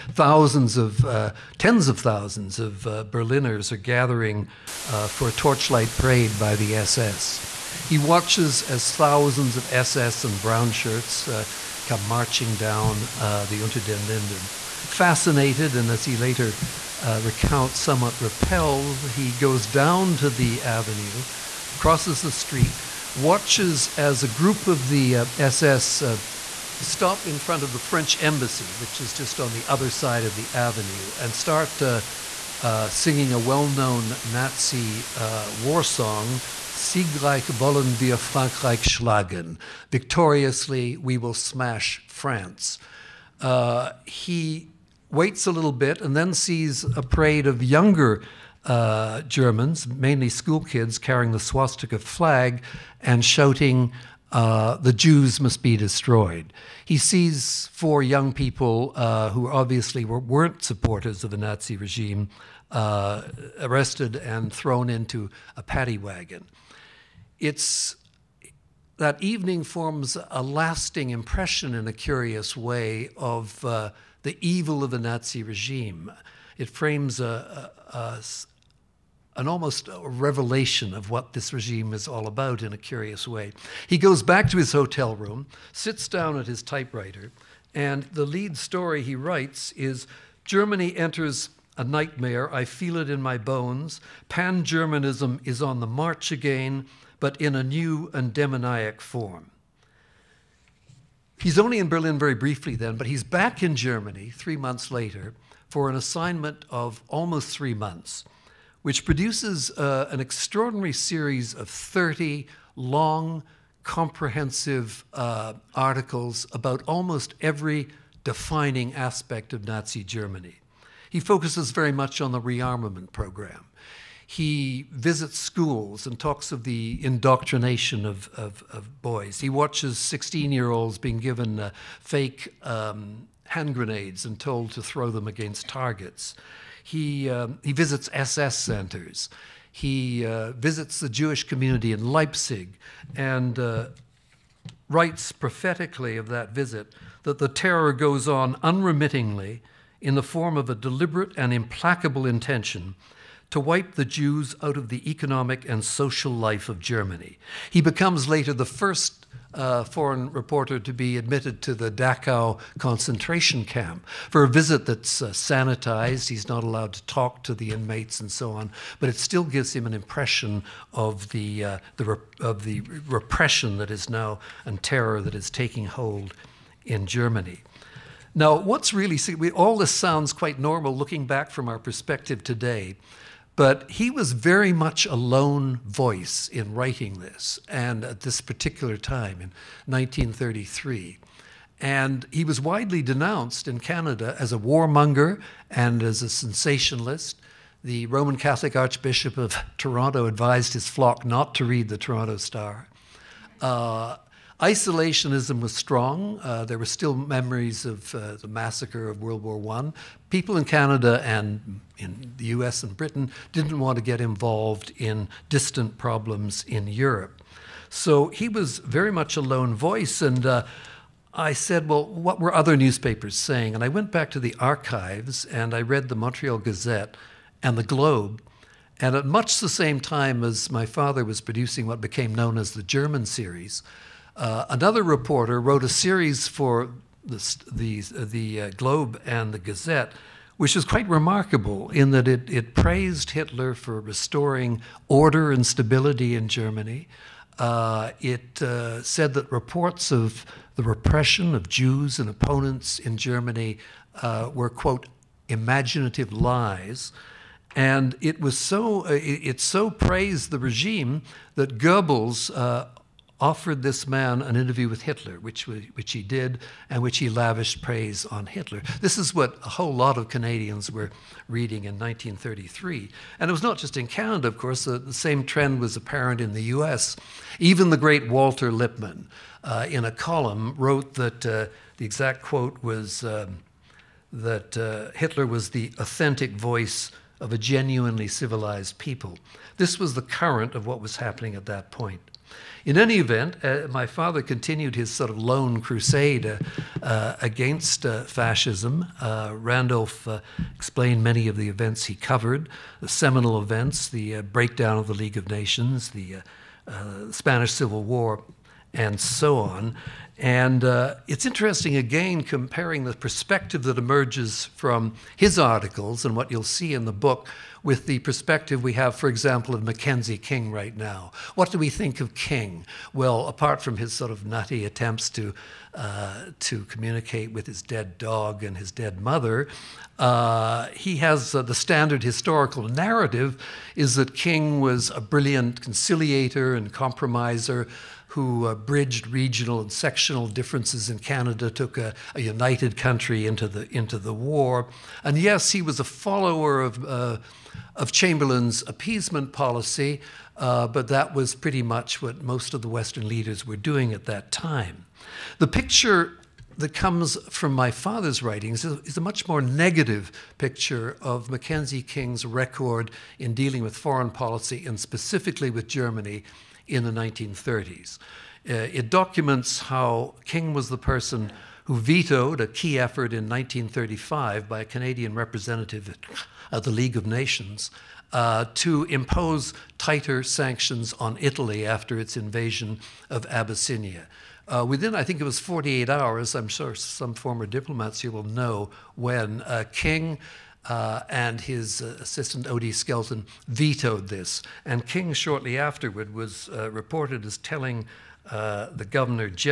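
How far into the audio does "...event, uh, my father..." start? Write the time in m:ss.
4:53.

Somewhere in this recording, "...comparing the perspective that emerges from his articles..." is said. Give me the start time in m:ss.
5:12.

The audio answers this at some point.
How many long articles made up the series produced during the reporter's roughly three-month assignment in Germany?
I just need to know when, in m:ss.
1:51.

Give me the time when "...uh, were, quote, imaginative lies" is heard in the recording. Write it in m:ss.
4:14.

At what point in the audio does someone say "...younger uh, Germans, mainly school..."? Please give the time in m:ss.
0:47.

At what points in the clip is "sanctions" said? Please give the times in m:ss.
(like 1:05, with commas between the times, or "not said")
6:20.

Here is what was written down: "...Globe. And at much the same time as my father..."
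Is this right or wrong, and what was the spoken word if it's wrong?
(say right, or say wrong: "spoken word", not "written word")
right.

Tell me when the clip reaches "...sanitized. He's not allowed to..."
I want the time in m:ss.
2:45.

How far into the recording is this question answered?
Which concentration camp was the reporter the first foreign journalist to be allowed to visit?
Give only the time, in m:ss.
2:41.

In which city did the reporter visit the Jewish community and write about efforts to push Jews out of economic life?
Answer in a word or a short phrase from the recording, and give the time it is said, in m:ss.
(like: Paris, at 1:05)
Leipzig, at 2:22.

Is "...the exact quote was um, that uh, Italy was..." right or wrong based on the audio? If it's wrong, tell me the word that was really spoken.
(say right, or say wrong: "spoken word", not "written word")
wrong: "Hitler", not "Italy".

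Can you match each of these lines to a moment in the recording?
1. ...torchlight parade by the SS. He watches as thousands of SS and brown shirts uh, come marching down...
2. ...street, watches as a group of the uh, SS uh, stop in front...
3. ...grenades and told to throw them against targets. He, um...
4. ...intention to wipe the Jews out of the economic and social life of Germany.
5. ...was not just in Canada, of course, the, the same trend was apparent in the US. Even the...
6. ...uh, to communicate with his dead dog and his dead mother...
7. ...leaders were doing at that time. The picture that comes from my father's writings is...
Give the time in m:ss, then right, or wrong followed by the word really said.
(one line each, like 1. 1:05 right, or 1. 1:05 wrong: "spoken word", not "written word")
1. 0:05 right
2. 0:22 right
3. 2:13 right
4. 2:32 right
5. 4:33 right
6. 5:25 right
7. 5:53 right.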